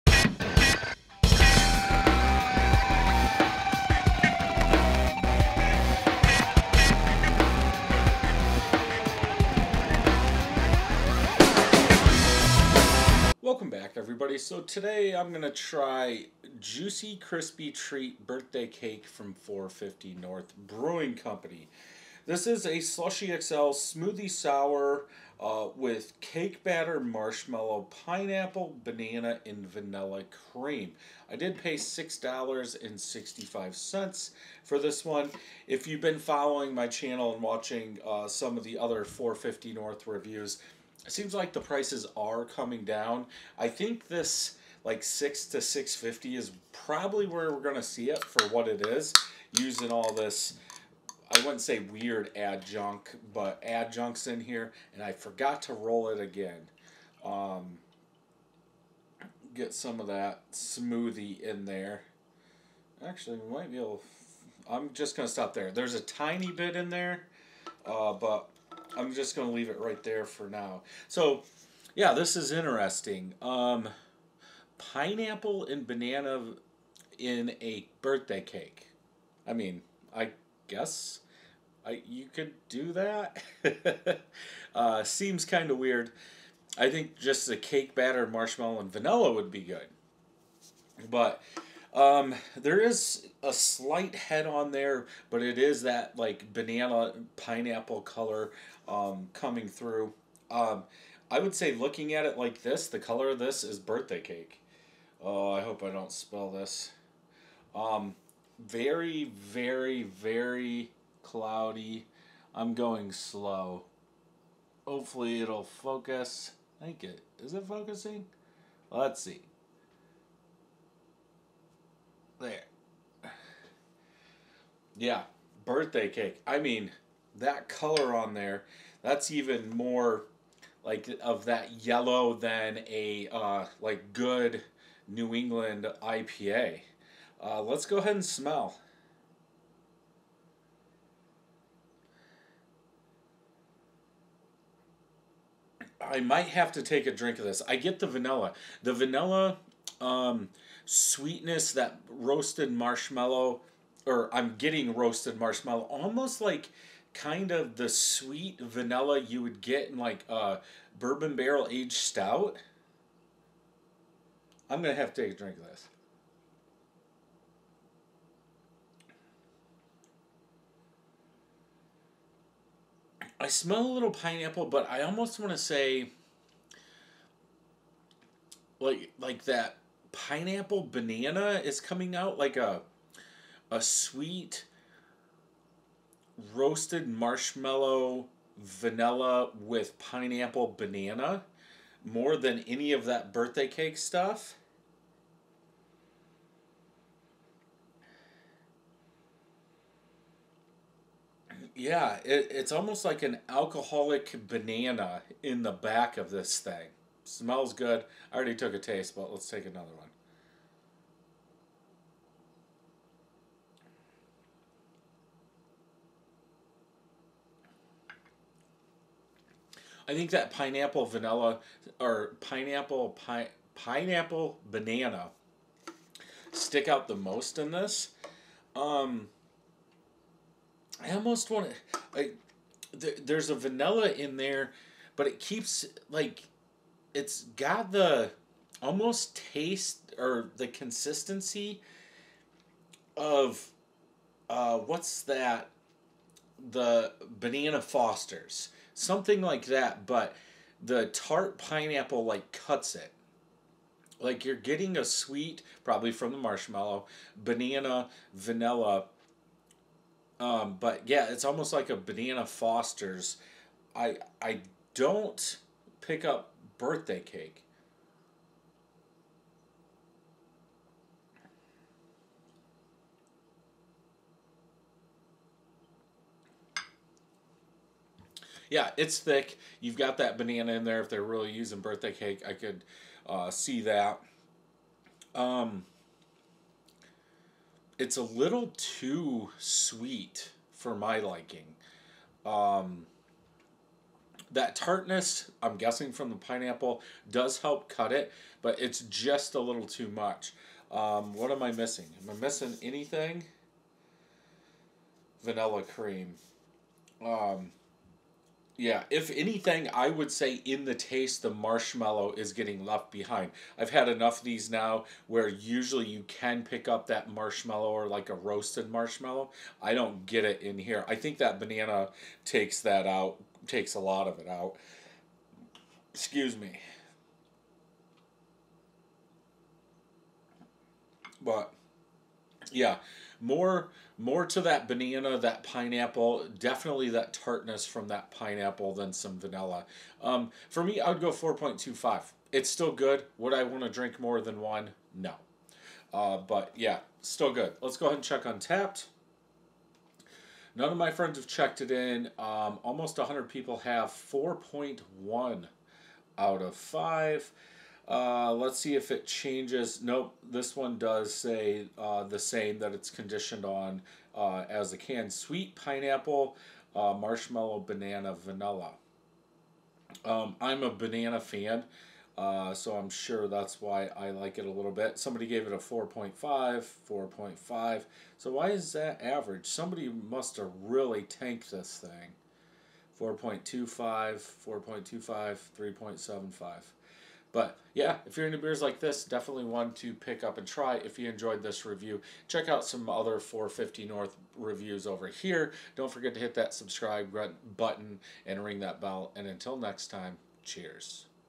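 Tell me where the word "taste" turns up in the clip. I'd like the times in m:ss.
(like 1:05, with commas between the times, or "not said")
3:28, 3:59, 5:10.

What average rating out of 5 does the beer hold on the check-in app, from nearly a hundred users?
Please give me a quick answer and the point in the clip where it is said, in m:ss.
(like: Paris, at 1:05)
4.1, at 5:54.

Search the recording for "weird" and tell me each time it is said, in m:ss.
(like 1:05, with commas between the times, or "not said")
0:51, 1:25.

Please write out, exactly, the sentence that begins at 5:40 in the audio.
Um, for me, I would go 4.25.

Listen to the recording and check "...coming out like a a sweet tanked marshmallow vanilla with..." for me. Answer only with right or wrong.
wrong.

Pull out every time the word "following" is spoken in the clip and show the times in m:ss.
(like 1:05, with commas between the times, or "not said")
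0:36.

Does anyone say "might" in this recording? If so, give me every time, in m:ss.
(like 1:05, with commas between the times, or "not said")
1:03, 2:26.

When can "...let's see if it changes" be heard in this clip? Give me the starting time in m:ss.
5:58.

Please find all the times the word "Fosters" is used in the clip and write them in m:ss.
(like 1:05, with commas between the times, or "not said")
4:07, 4:22.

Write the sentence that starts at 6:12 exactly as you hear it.
Uh, so I'm sure that's why I like it a little bit.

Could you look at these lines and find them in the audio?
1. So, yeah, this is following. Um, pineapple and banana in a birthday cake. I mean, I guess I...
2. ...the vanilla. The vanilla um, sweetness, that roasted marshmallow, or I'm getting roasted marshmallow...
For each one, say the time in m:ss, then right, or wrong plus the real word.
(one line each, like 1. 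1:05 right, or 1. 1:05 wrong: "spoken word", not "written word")
1. 1:11 wrong: "interesting", not "following"
2. 2:27 right.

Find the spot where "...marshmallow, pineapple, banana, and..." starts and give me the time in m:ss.
0:27.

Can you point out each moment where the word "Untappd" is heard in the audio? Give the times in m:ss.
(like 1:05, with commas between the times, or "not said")
5:48.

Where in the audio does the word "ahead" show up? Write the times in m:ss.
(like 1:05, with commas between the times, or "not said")
2:17, 5:48.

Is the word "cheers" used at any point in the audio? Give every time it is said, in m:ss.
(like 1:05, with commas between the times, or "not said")
6:40.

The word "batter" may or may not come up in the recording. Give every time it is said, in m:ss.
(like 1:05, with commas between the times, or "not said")
0:26, 1:27.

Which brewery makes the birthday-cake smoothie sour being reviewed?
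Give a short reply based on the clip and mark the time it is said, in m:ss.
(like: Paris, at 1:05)
450 North Brewing Company, at 0:19.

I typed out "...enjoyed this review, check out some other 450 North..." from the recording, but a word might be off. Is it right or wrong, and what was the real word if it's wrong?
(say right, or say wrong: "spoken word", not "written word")
right.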